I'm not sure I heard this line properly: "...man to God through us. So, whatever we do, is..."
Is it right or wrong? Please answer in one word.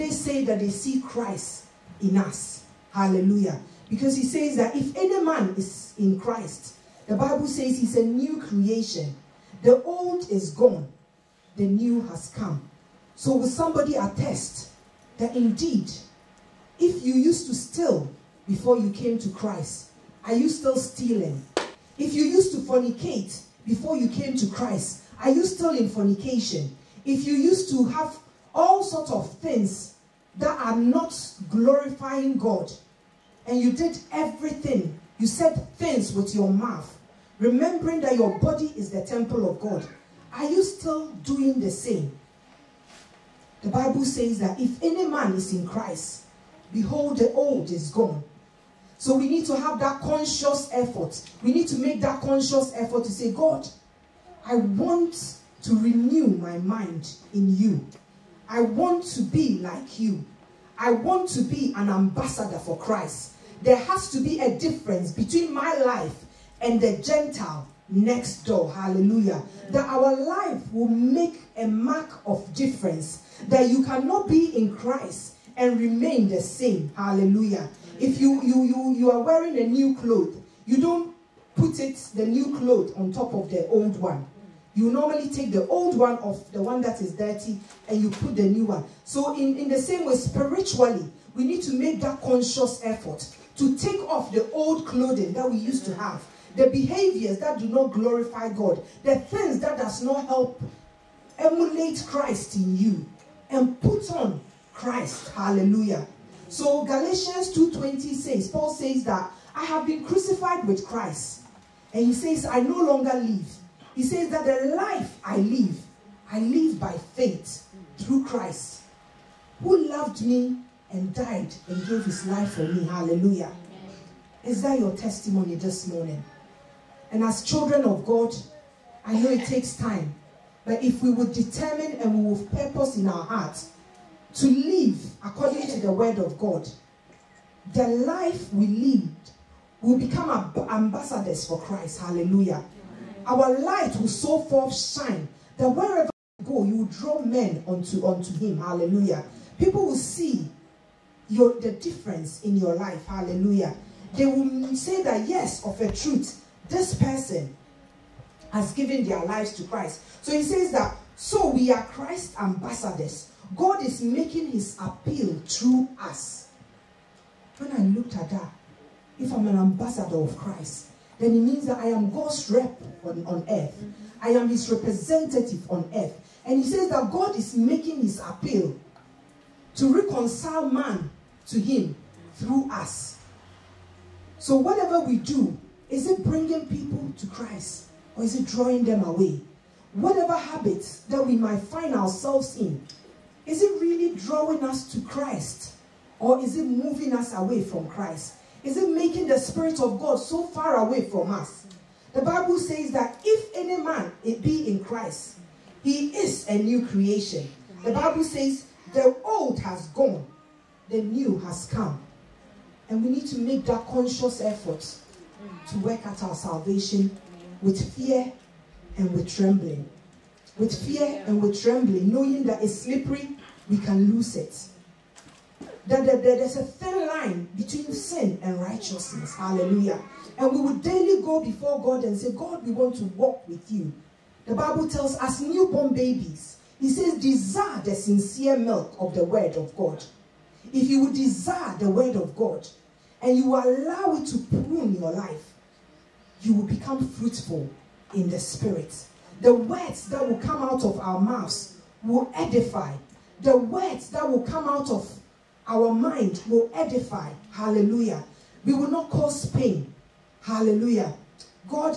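wrong.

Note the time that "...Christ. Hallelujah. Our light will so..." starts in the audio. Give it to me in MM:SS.
02:21.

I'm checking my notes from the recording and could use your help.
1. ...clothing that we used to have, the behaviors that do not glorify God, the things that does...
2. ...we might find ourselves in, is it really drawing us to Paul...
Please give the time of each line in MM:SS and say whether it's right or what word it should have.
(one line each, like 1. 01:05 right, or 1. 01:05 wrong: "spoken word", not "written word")
1. 01:34 right
2. 03:11 wrong: "Christ", not "Paul".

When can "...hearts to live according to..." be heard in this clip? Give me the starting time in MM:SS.
02:13.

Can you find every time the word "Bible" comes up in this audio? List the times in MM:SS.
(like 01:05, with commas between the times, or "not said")
00:07, 00:43, 03:22, 03:27, 03:54.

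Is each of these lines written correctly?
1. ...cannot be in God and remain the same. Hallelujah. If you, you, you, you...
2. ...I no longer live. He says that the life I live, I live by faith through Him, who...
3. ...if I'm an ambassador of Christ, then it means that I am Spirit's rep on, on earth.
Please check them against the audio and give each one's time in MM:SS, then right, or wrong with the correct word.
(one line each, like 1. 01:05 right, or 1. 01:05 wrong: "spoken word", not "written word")
1. 01:13 wrong: "Christ", not "God"
2. 01:52 wrong: "Christ", not "Him"
3. 02:49 wrong: "God", not "Spirit".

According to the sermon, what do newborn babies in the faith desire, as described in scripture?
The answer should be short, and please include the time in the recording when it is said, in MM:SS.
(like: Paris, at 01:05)
sincere milk, at 03:57.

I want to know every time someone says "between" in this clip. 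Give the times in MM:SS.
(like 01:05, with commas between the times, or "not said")
01:05, 03:47.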